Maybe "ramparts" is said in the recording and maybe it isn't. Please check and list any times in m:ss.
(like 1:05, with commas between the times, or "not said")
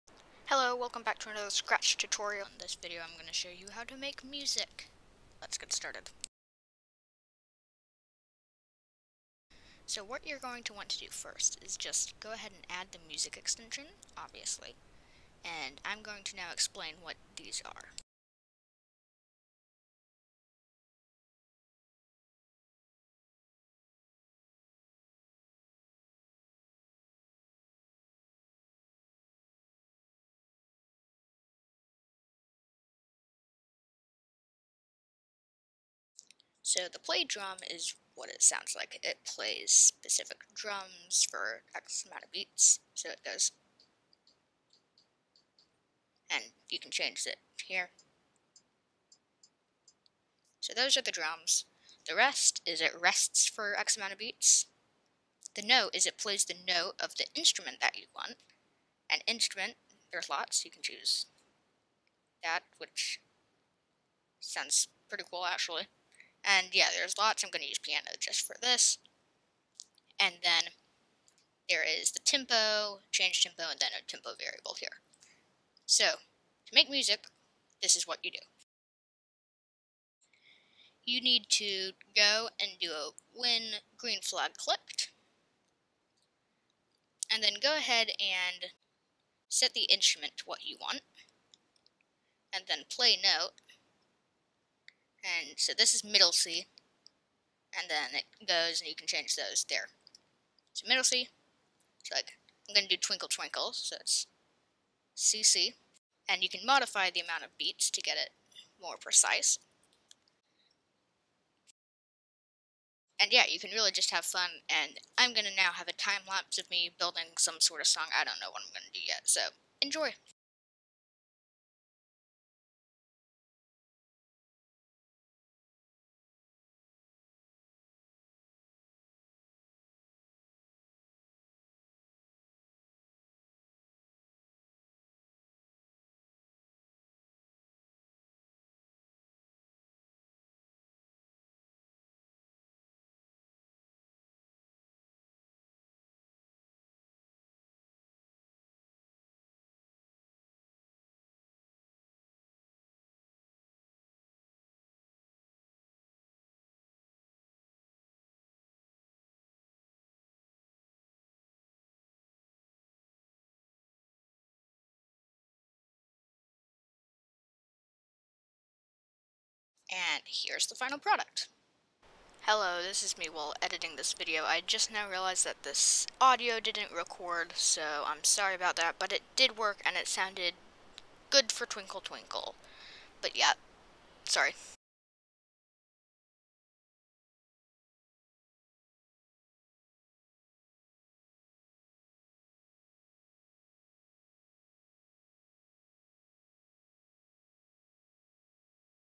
not said.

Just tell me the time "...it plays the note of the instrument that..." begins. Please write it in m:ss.
0:56.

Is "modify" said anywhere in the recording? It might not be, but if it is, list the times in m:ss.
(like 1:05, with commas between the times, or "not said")
1:46.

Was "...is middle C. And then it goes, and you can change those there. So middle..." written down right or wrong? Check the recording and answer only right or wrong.
right.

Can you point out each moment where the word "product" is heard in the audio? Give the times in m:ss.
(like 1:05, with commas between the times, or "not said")
2:50.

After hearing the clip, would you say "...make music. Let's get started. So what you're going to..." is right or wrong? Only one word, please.
right.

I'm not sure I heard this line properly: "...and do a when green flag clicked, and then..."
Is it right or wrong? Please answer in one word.
right.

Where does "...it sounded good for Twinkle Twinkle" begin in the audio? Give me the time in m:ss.
2:59.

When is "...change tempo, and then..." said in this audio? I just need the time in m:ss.
1:13.